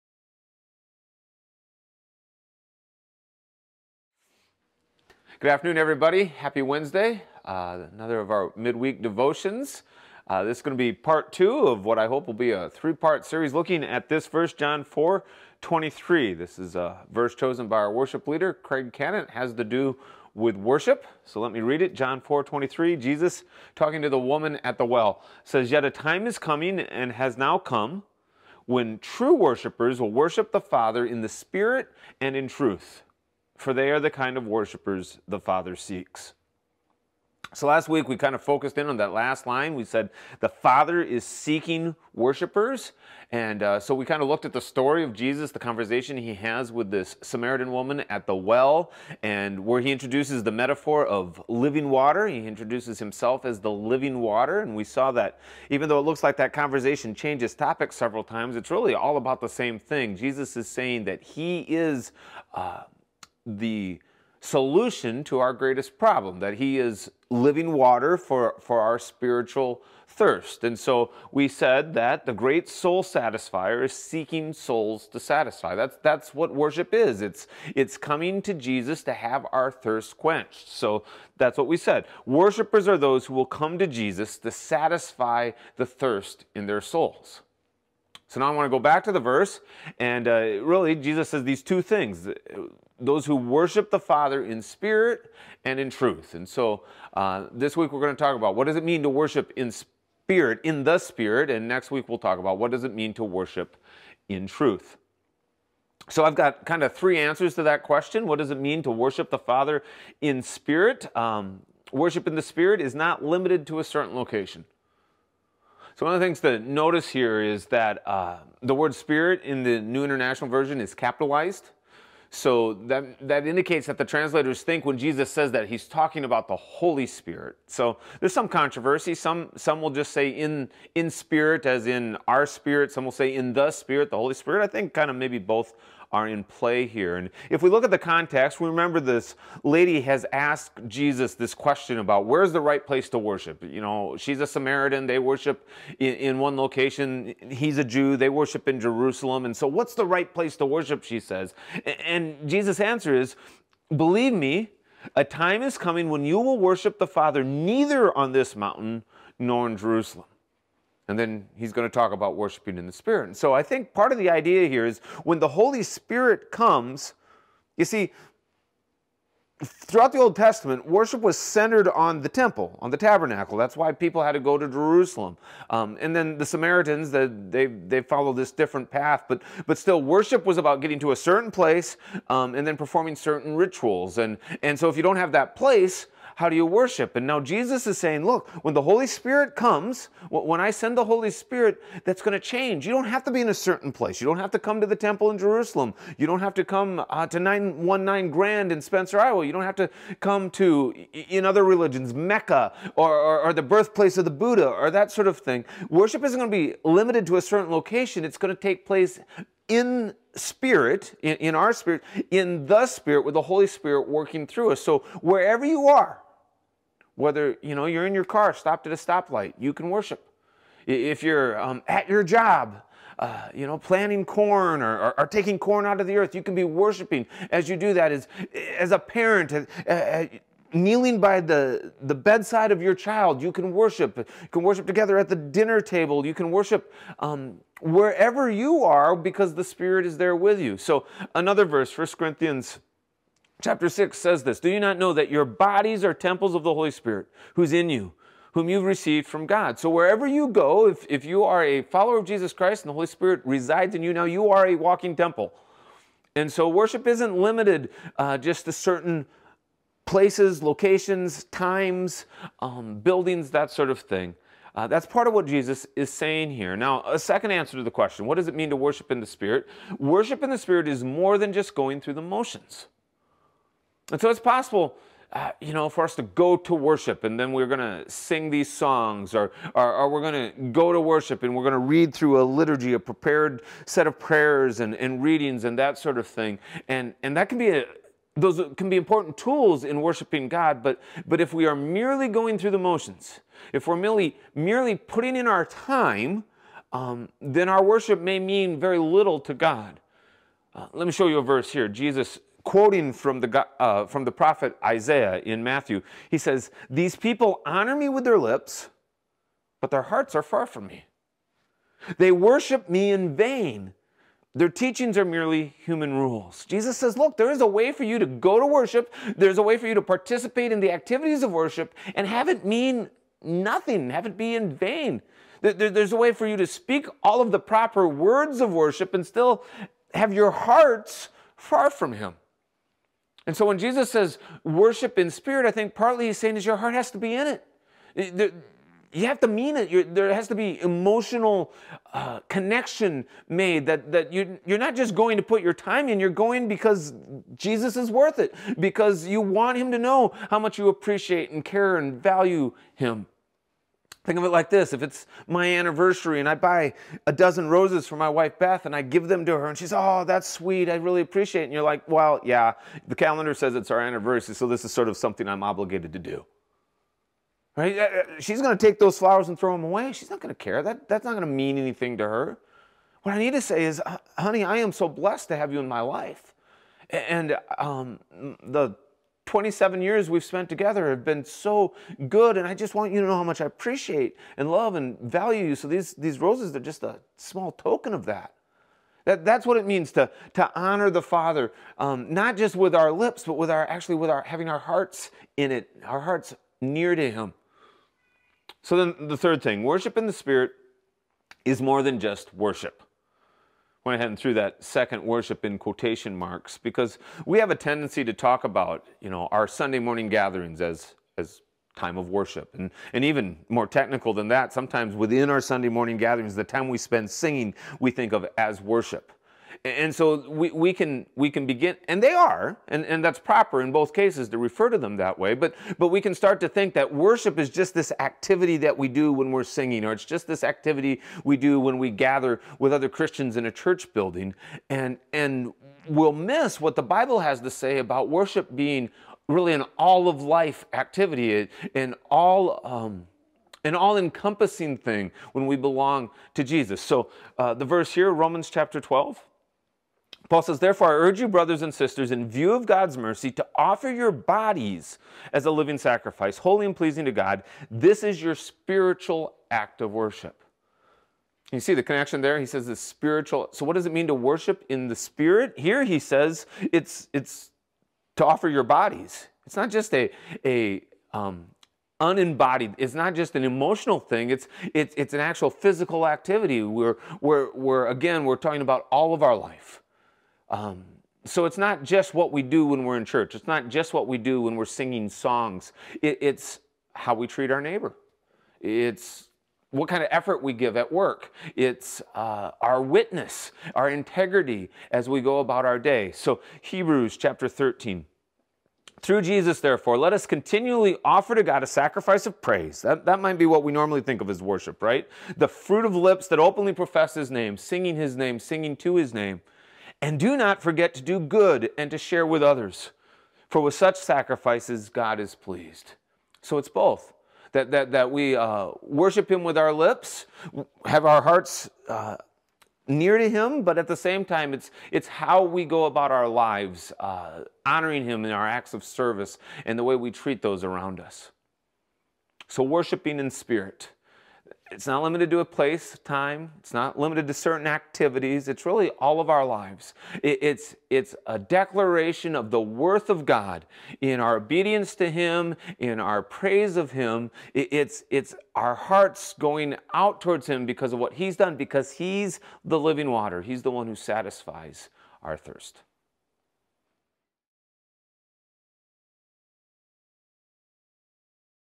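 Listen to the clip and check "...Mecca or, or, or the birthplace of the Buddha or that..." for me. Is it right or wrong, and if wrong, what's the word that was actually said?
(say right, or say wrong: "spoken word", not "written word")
right.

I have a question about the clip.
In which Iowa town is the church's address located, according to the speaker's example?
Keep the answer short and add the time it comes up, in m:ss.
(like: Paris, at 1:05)
Spencer, at 3:18.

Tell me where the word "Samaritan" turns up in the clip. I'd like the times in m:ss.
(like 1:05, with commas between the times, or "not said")
0:47, 2:24, 2:56.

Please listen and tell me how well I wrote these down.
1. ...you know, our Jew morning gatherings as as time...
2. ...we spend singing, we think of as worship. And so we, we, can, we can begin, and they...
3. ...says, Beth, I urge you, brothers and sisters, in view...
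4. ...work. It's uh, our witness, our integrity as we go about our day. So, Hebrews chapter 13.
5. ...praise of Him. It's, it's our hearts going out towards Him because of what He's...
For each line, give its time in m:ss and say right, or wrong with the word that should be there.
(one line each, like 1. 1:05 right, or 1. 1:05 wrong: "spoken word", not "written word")
1. 6:49 wrong: "Sunday", not "Jew"
2. 6:56 right
3. 7:30 wrong: "Therefore", not "Beth"
4. 8:11 right
5. 9:06 right.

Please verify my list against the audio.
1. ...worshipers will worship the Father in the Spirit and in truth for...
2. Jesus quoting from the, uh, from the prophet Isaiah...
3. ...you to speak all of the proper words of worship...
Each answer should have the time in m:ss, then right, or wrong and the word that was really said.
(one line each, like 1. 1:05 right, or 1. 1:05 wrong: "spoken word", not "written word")
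1. 0:29 right
2. 5:01 right
3. 5:26 right.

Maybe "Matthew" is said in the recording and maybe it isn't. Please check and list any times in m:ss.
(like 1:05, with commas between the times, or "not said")
5:05.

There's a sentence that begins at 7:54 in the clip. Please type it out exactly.
It's it's it's an actual physical activity.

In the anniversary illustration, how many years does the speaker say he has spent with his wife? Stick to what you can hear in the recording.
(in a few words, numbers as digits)
27.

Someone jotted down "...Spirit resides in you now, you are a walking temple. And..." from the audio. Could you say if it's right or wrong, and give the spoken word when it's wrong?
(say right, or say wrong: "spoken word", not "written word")
right.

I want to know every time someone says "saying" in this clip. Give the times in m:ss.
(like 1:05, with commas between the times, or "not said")
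1:00, 3:07, 4:26, 5:36.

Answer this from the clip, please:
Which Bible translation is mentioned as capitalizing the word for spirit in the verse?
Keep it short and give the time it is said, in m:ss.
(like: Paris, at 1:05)
New International Version, at 1:59.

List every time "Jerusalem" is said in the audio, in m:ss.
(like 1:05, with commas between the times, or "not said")
2:28, 2:39, 2:54, 3:15.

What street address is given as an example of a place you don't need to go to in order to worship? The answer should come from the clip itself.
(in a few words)
919 Grand.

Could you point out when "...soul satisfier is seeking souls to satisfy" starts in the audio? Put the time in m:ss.
1:12.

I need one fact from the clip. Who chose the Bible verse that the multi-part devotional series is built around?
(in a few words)
Craig Cannon.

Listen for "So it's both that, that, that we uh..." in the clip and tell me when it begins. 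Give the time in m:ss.
8:36.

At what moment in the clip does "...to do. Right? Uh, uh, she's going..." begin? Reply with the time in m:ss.
6:06.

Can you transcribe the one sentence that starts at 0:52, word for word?
He introduces himself as the living water.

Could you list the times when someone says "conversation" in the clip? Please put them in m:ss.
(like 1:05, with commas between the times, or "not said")
0:45, 0:56.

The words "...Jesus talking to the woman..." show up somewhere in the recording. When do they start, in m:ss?
0:22.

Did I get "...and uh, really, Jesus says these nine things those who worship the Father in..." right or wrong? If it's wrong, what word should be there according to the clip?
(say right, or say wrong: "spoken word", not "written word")
wrong: "two", not "nine".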